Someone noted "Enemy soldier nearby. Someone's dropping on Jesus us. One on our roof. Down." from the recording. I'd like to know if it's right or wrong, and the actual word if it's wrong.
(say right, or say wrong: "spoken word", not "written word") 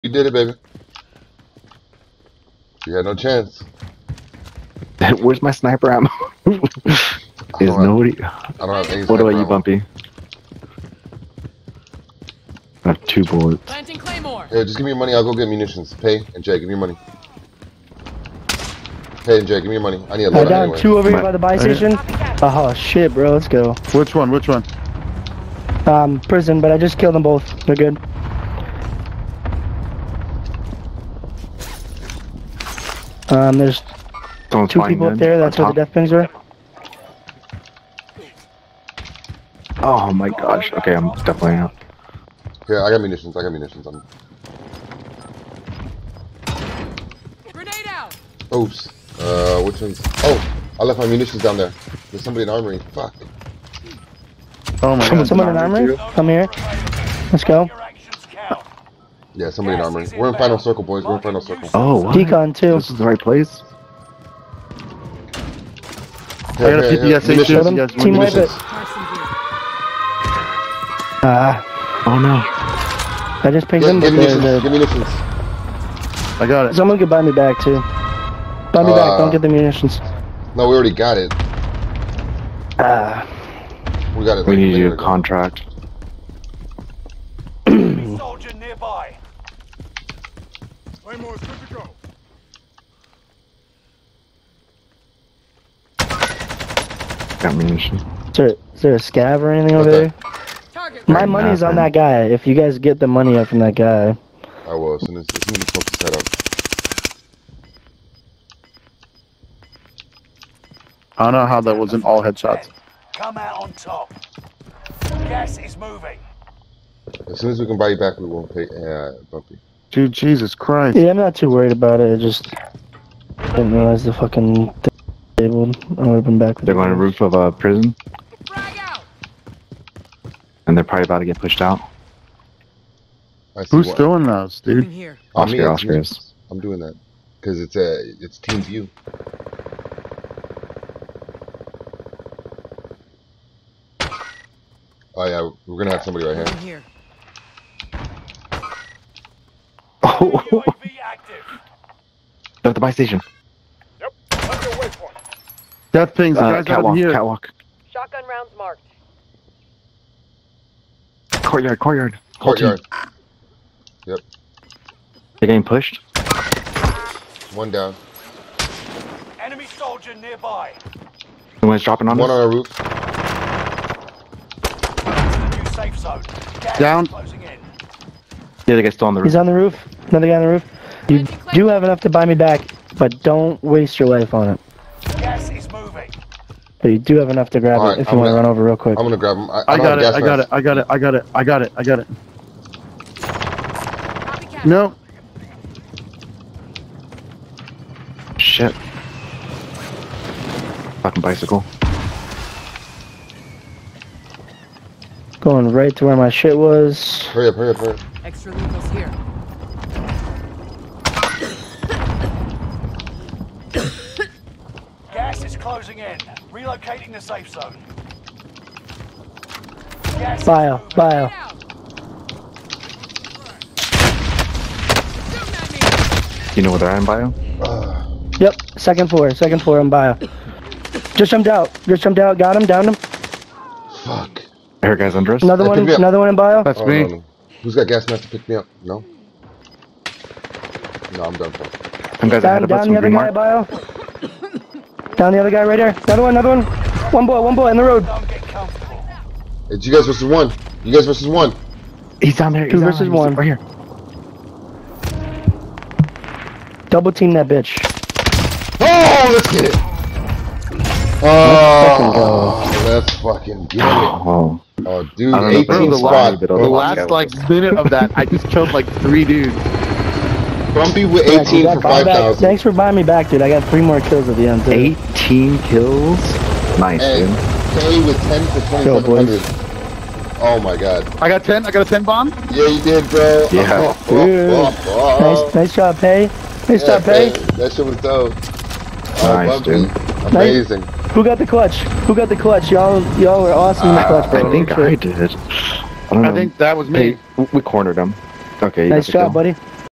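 wrong: "One", not "Jesus".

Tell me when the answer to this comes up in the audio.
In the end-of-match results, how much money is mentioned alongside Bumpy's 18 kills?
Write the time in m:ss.
4:31.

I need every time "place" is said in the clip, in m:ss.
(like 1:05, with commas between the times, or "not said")
1:03.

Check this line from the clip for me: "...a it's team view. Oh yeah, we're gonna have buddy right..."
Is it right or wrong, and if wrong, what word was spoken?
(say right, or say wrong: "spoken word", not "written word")
wrong: "somebody", not "buddy".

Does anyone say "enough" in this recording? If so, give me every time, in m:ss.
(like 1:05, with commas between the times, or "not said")
3:01, 3:07.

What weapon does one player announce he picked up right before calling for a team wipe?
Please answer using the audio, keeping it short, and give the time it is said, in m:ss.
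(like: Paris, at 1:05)
PPS, at 1:06.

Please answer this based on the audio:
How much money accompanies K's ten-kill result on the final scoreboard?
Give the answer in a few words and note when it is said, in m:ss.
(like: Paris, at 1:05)
2,700, at 4:39.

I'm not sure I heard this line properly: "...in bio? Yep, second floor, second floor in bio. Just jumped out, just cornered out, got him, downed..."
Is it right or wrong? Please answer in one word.
wrong.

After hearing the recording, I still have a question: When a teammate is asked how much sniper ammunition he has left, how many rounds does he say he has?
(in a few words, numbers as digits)
2.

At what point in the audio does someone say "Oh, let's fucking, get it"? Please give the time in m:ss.
4:21.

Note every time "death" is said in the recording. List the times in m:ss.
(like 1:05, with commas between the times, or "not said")
0:35.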